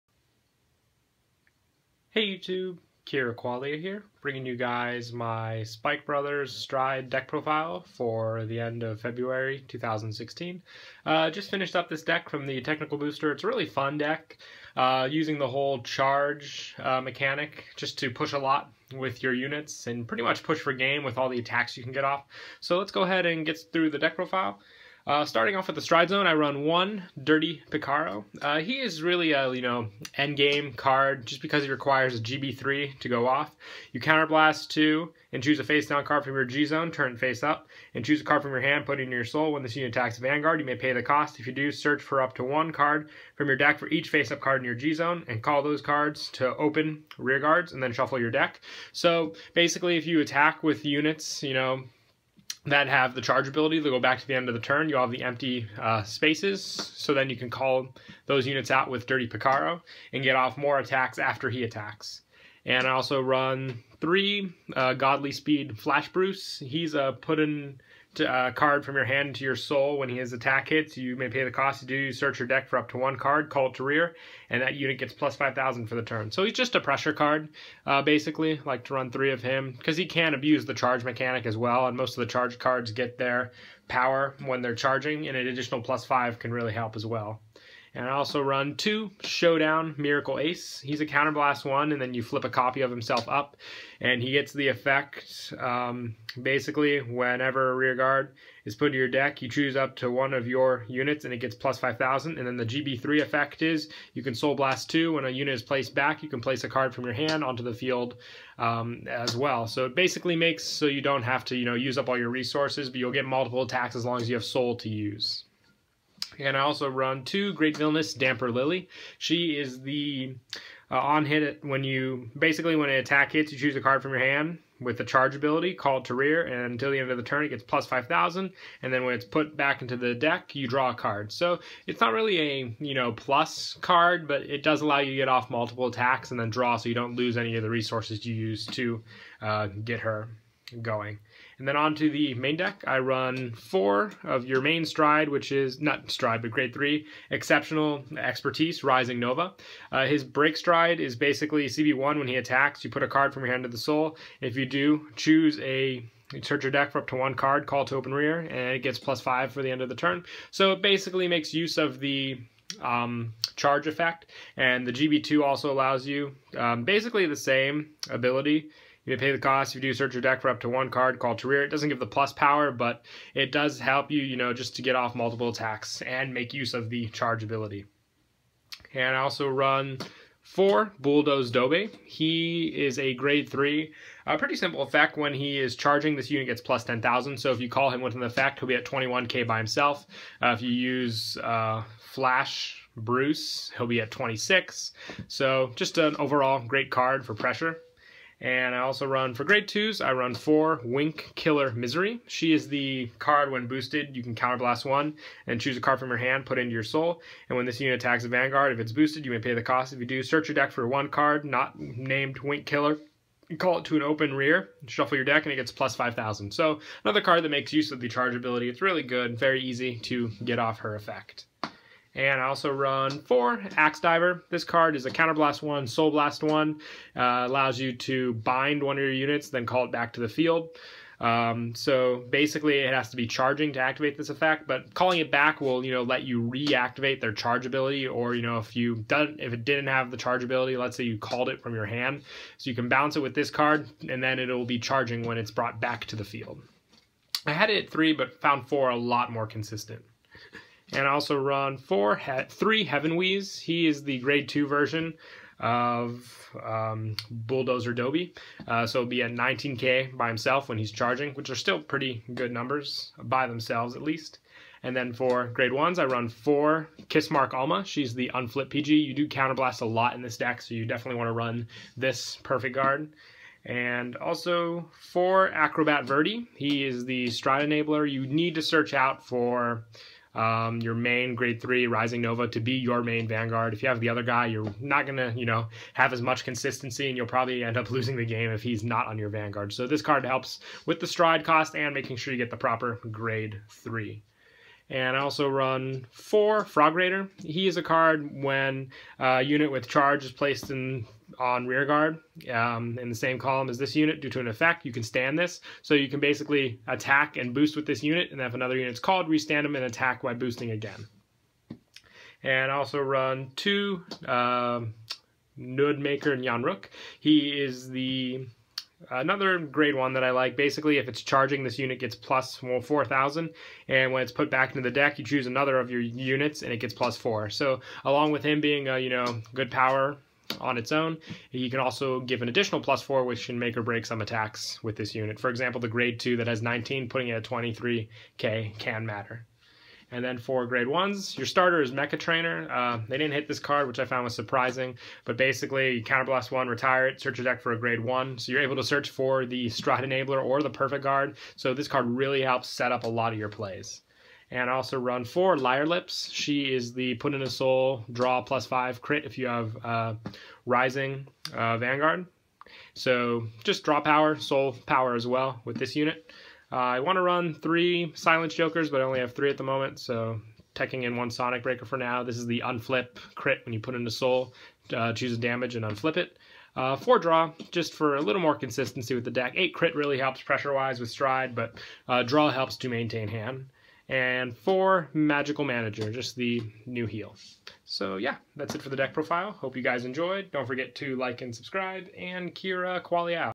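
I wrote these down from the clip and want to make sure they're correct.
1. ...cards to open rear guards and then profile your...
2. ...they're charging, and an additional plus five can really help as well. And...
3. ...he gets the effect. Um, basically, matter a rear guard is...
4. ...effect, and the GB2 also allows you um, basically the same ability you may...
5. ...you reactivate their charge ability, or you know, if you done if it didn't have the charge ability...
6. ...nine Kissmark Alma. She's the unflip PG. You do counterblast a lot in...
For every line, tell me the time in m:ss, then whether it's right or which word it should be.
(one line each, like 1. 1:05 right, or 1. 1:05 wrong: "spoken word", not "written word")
1. 0:45 wrong: "shuffle", not "profile"
2. 1:24 right
3. 1:34 wrong: "whenever", not "matter"
4. 2:43 right
5. 3:56 right
6. 4:26 wrong: "four", not "nine".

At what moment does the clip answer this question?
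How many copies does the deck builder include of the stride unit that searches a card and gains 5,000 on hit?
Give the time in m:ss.
1:03.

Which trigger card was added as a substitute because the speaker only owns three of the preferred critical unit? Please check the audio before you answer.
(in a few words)
Sonic Breaker.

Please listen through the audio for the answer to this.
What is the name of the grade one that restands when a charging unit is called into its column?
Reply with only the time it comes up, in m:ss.
4:56.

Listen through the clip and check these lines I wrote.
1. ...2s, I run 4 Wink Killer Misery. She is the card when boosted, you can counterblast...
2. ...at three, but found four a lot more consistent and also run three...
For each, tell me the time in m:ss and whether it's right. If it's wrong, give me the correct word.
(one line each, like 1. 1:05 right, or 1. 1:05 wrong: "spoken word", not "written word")
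1. 3:19 right
2. 4:07 wrong: "four", not "three".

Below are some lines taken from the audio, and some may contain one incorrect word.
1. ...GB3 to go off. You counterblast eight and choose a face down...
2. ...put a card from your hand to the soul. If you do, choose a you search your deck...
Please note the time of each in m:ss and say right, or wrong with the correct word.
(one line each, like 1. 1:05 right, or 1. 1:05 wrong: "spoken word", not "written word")
1. 0:32 wrong: "two", not "eight"
2. 2:32 right.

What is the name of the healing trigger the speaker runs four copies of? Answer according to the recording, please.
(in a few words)
Magical Manager.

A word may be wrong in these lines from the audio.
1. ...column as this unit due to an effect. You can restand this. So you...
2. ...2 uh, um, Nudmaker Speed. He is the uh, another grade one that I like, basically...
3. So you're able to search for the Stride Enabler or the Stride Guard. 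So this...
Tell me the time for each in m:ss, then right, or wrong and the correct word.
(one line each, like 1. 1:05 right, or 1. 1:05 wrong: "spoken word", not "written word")
1. 5:03 wrong: "stand", not "restand"
2. 5:13 wrong: "Nyanruk", not "Speed"
3. 5:48 wrong: "Perfect", not "Stride".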